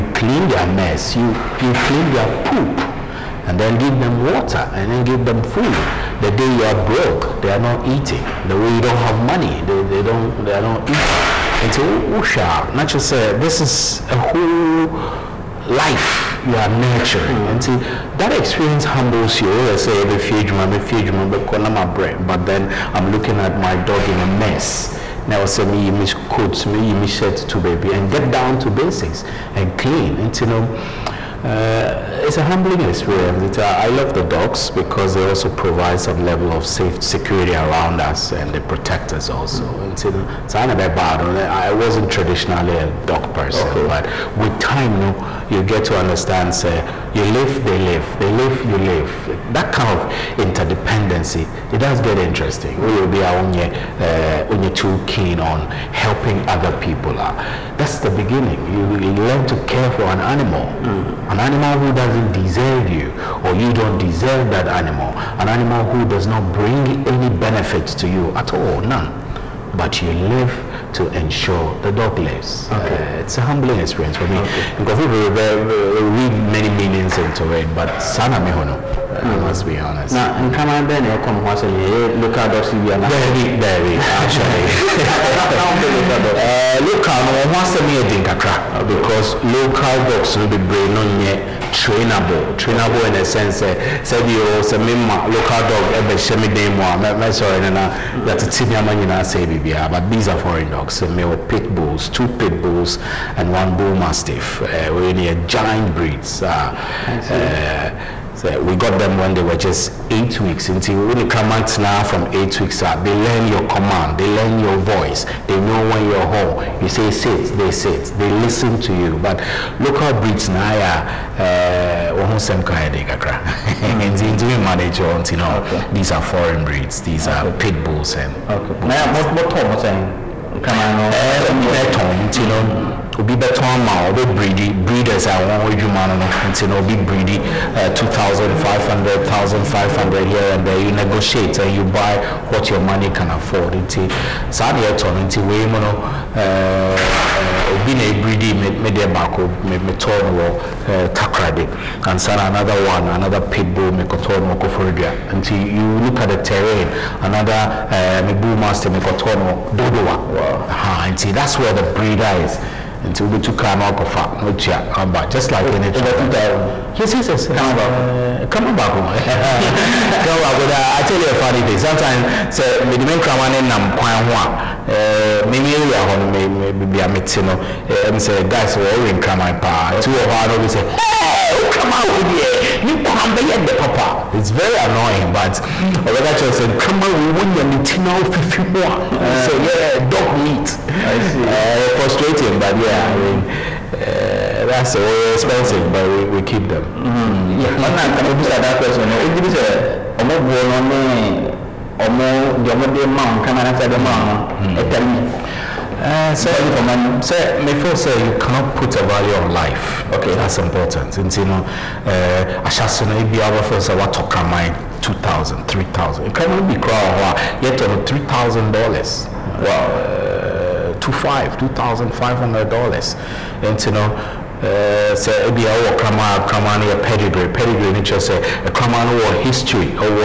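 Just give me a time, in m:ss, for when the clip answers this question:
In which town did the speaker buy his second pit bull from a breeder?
2:34.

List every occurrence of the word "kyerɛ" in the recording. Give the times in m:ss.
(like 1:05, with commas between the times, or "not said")
3:06, 3:48.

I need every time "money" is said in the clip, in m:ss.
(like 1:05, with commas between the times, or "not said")
0:09, 2:22, 3:26.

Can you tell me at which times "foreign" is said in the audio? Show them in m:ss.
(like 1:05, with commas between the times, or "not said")
1:40, 2:06.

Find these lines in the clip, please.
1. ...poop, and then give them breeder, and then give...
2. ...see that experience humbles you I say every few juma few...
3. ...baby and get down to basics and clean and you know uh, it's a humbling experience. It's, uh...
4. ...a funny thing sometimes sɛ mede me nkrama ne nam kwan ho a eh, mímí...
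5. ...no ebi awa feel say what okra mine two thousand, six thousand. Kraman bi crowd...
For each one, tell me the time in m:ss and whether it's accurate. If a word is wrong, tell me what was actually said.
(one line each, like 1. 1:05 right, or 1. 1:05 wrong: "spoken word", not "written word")
1. 0:02 wrong: "water", not "breeder"
2. 0:17 right
3. 0:27 right
4. 2:51 right
5. 3:33 wrong: "three", not "six".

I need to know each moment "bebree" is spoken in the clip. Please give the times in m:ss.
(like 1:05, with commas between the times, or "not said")
1:30.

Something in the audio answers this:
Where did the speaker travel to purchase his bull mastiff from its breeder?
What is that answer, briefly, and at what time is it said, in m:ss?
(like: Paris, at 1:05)
Dodoa, at 2:39.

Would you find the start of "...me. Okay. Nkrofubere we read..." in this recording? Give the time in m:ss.
1:14.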